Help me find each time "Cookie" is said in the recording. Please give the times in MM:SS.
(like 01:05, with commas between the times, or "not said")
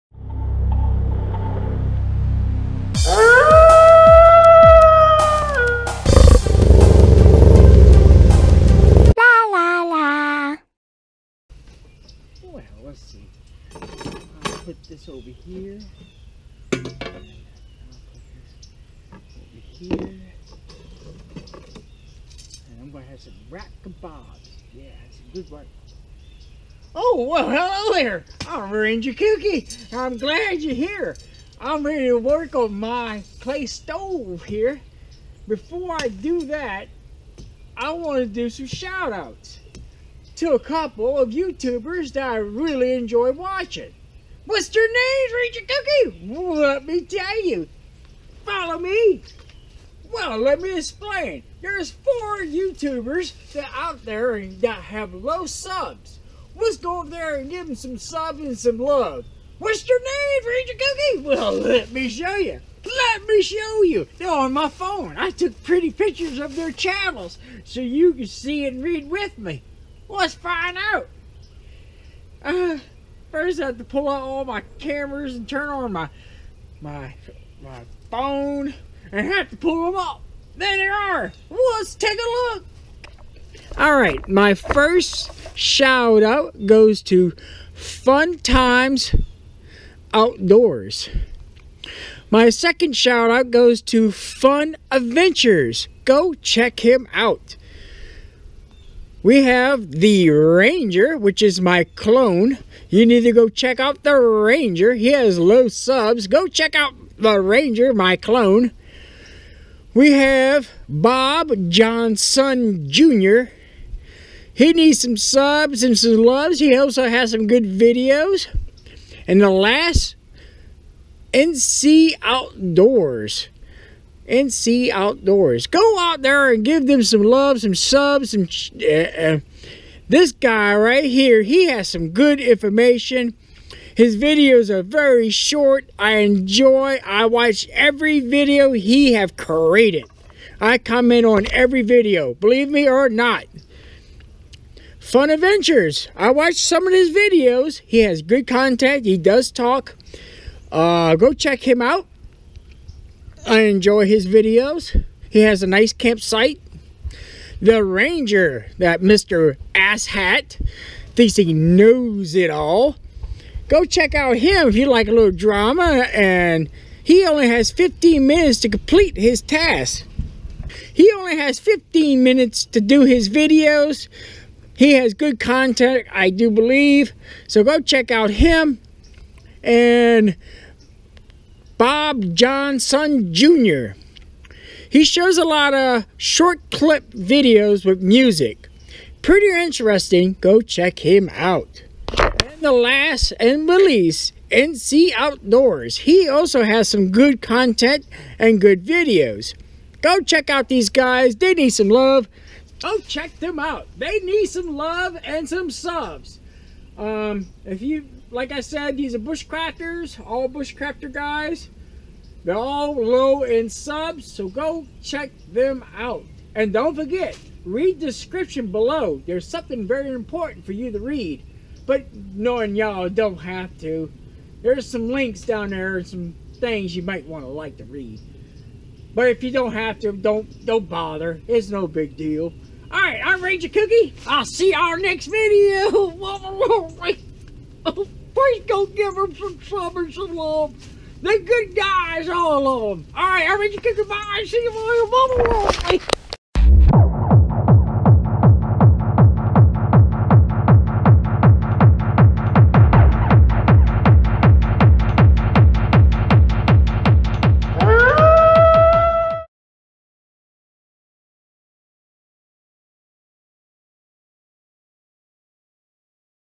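00:45, 01:00.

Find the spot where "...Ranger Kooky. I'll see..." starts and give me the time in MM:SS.
03:53.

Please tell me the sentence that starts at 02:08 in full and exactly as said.
Uh, uh, this guy right here, he has some good information.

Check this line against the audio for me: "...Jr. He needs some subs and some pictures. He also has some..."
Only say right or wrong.
wrong.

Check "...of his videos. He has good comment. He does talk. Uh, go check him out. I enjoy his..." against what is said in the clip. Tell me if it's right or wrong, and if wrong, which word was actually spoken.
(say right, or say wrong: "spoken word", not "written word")
wrong: "content", not "comment".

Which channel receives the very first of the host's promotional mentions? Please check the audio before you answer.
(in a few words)
Fun Times Outdoors.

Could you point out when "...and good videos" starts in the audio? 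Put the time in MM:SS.
03:18.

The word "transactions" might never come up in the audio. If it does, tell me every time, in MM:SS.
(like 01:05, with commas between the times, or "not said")
not said.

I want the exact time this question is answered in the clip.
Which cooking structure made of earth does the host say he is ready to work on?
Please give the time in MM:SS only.
00:33.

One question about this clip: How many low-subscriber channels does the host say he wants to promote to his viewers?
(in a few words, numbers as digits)
4.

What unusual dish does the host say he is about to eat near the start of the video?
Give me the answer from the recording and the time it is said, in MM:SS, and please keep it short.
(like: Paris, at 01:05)
rat kebabs, at 00:23.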